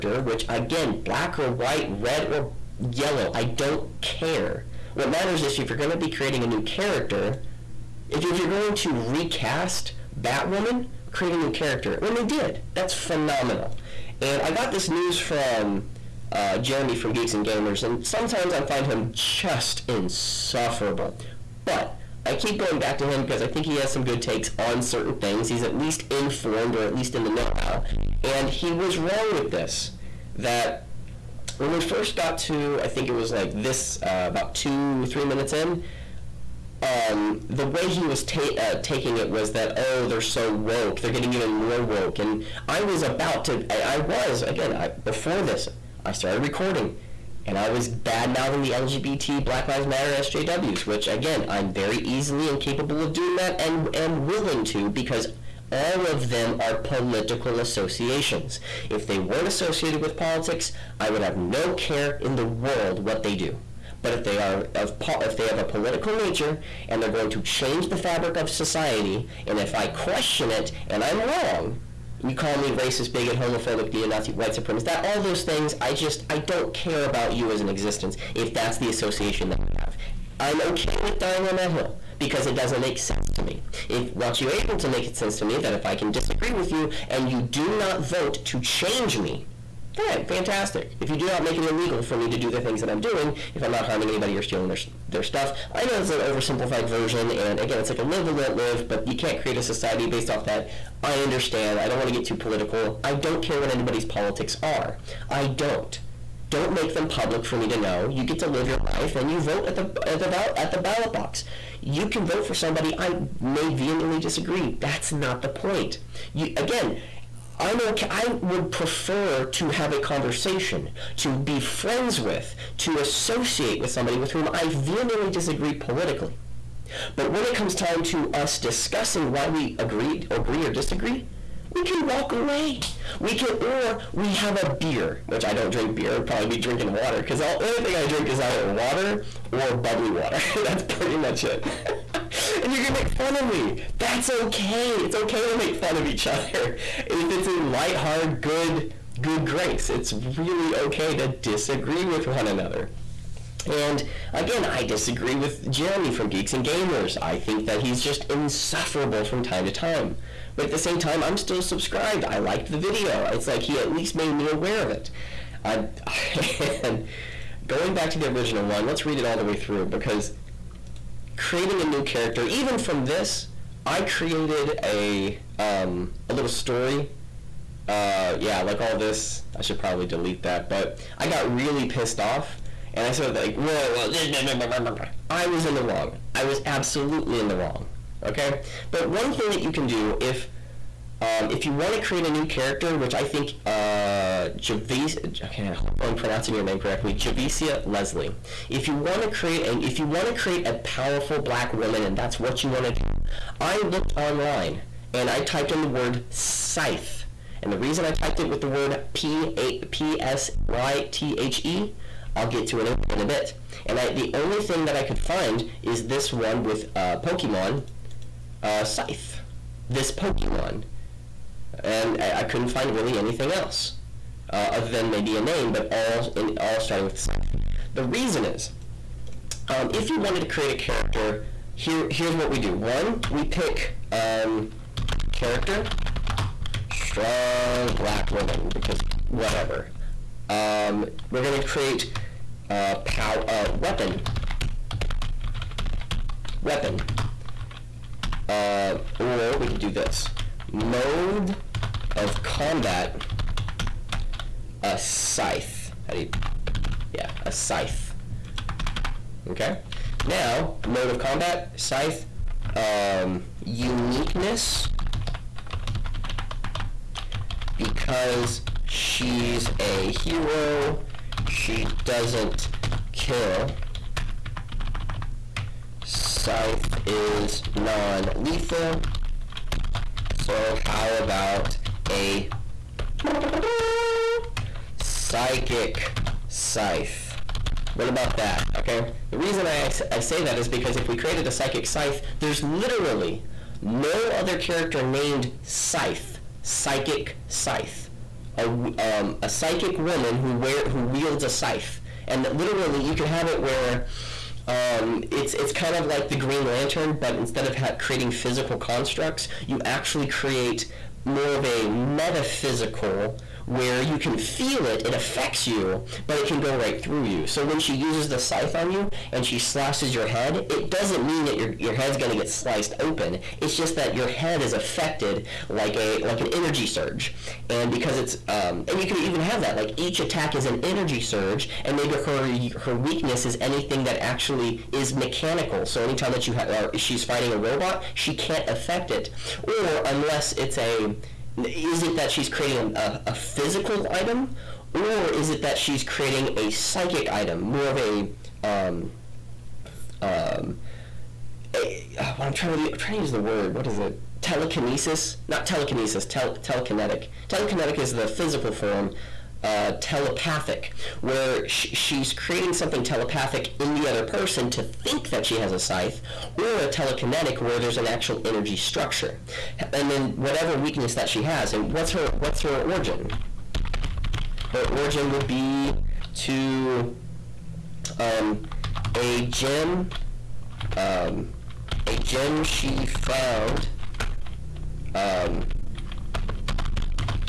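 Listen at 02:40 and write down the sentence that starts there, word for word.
But at the same time, I'm still subscribed.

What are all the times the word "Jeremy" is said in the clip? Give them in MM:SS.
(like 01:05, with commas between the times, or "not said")
00:16, 02:35.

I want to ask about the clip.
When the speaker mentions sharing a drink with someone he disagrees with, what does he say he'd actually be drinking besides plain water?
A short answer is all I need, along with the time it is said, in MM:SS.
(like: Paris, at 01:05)
bubbly water, at 02:19.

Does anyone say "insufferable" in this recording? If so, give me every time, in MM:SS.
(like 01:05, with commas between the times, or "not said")
00:19, 02:38.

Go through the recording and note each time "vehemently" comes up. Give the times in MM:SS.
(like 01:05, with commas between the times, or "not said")
01:53, 02:04.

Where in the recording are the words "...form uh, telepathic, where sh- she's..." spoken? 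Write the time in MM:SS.
05:58.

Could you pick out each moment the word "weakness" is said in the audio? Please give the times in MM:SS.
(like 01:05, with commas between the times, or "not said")
05:32, 06:10.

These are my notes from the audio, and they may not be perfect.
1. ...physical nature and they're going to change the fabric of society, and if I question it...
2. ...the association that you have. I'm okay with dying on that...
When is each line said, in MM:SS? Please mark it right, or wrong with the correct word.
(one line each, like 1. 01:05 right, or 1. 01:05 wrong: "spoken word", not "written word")
1. 01:05 wrong: "political", not "physical"
2. 01:18 right.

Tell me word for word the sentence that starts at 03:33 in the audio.
And I, the only thing that I could find is this one with uh, Pokemon uh, Scythe.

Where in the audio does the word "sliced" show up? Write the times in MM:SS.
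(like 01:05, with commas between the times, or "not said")
05:22.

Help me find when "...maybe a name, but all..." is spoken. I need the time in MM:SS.
03:45.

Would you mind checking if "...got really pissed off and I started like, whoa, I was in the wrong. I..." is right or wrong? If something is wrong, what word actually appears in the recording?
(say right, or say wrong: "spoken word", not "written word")
right.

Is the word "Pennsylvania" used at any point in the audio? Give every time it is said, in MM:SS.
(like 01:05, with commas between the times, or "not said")
not said.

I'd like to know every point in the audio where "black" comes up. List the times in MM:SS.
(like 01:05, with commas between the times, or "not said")
00:01, 00:49, 03:21, 03:57.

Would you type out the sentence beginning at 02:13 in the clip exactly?
We can, or we have a beer, which I don't drink beer.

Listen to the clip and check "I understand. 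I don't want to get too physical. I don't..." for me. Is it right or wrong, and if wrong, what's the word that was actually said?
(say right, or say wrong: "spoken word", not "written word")
wrong: "political", not "physical".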